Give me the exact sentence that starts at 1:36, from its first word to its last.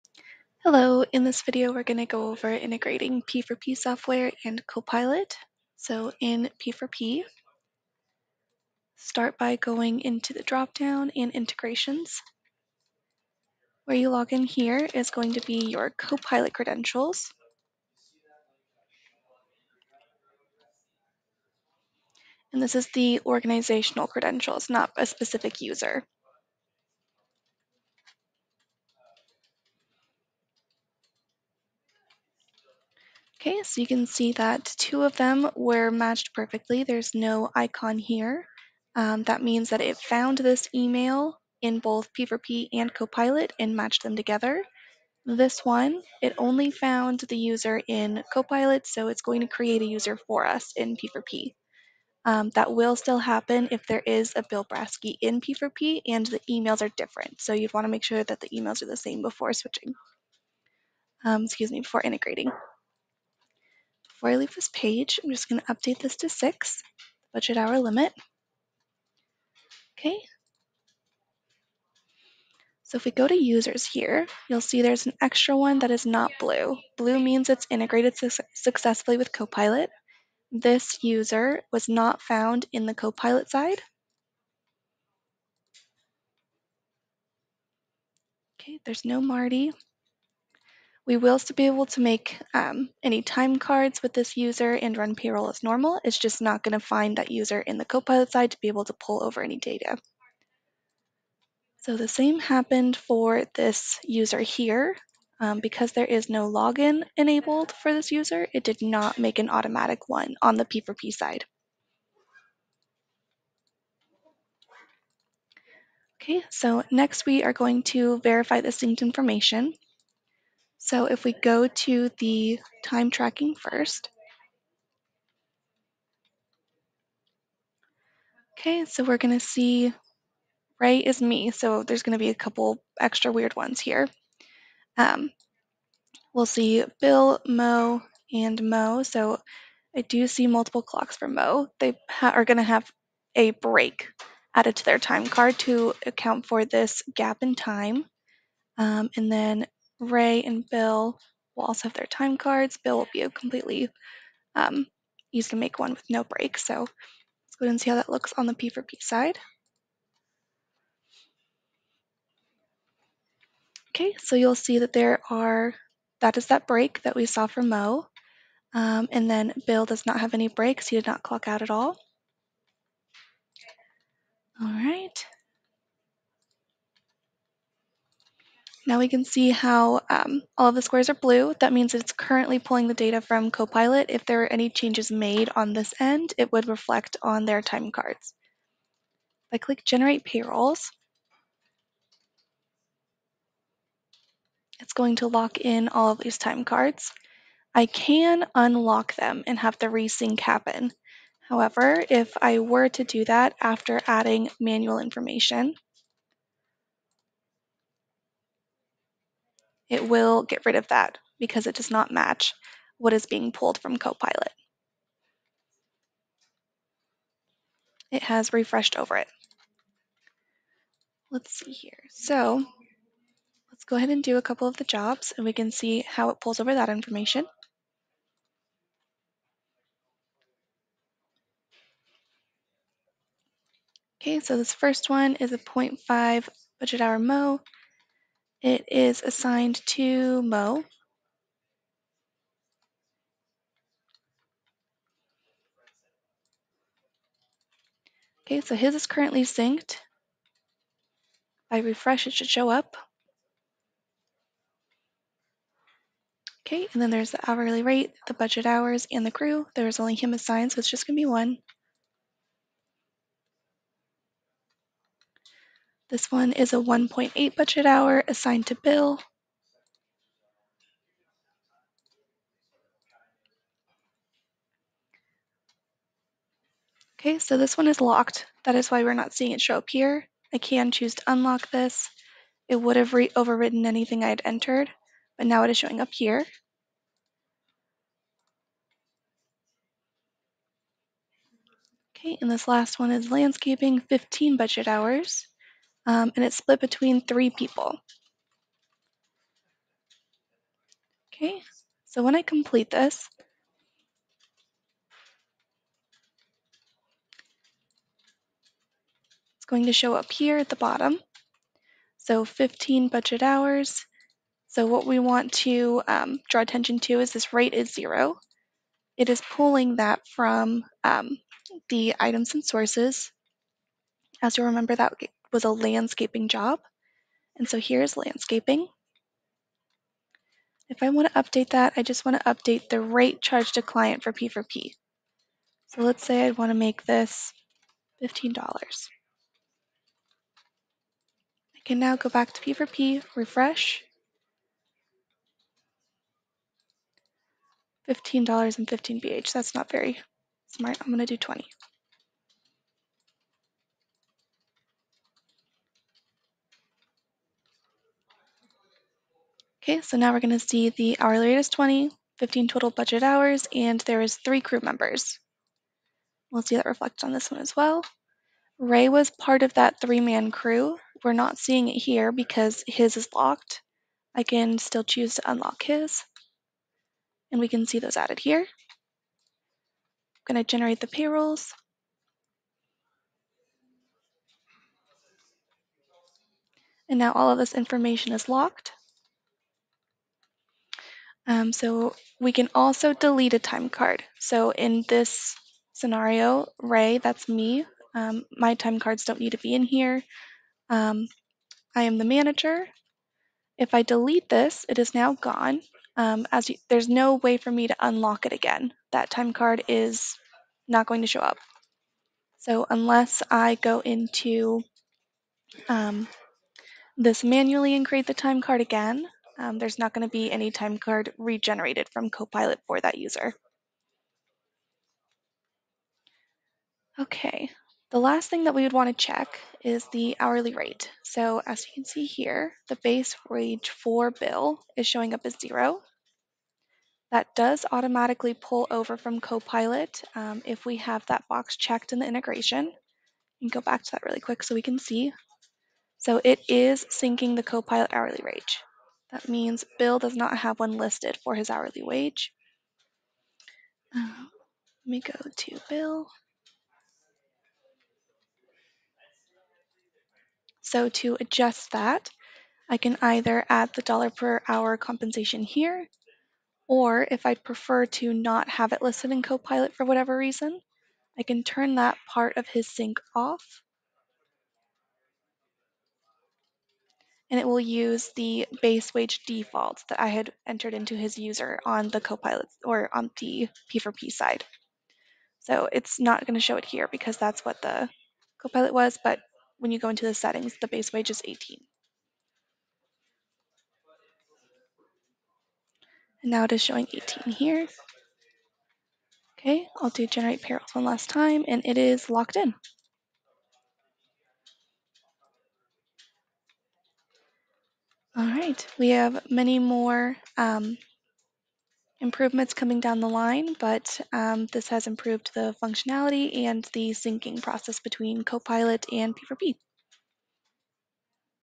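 It's just not going to find that user in the Copilot side to be able to pull over any data.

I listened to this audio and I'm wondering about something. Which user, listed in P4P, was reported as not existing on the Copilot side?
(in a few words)
Marty.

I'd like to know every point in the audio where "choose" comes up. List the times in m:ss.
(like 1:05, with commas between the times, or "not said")
4:40, 6:15.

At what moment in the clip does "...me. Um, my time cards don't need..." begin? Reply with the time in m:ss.
6:37.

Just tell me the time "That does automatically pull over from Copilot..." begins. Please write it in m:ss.
7:17.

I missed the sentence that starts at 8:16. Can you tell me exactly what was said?
And now it is showing 18 here.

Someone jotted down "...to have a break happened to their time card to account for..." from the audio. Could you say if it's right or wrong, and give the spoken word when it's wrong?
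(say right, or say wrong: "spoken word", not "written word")
wrong: "added", not "happened".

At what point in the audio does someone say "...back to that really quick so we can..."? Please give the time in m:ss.
7:23.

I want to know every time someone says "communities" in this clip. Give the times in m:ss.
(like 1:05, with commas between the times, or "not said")
not said.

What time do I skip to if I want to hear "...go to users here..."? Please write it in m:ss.
1:13.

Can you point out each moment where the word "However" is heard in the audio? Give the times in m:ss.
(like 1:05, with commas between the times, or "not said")
3:21.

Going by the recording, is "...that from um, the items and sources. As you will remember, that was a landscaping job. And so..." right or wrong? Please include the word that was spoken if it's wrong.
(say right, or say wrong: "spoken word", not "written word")
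right.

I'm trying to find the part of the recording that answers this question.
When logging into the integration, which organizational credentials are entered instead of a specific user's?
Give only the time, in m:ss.
0:15.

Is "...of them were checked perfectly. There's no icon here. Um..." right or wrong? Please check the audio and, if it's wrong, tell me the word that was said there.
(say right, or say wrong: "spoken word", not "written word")
wrong: "matched", not "checked".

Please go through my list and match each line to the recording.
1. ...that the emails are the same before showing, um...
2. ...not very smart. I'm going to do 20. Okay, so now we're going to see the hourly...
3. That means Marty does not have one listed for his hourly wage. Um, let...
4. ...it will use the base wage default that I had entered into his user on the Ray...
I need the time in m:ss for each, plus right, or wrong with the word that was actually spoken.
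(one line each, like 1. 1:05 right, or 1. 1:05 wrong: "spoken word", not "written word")
1. 0:58 wrong: "switching", not "showing"
2. 5:49 right
3. 7:29 wrong: "Bill", not "Marty"
4. 7:57 wrong: "Copilot", not "Ray".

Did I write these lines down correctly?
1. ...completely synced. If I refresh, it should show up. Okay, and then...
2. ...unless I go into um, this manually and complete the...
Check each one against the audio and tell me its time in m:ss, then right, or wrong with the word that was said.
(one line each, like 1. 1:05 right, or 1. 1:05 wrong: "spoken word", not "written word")
1. 4:09 wrong: "currently", not "completely"
2. 6:52 wrong: "create", not "complete".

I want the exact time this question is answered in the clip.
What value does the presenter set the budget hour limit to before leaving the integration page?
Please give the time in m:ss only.
1:06.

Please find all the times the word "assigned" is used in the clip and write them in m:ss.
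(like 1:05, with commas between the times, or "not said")
3:59, 4:20, 4:28.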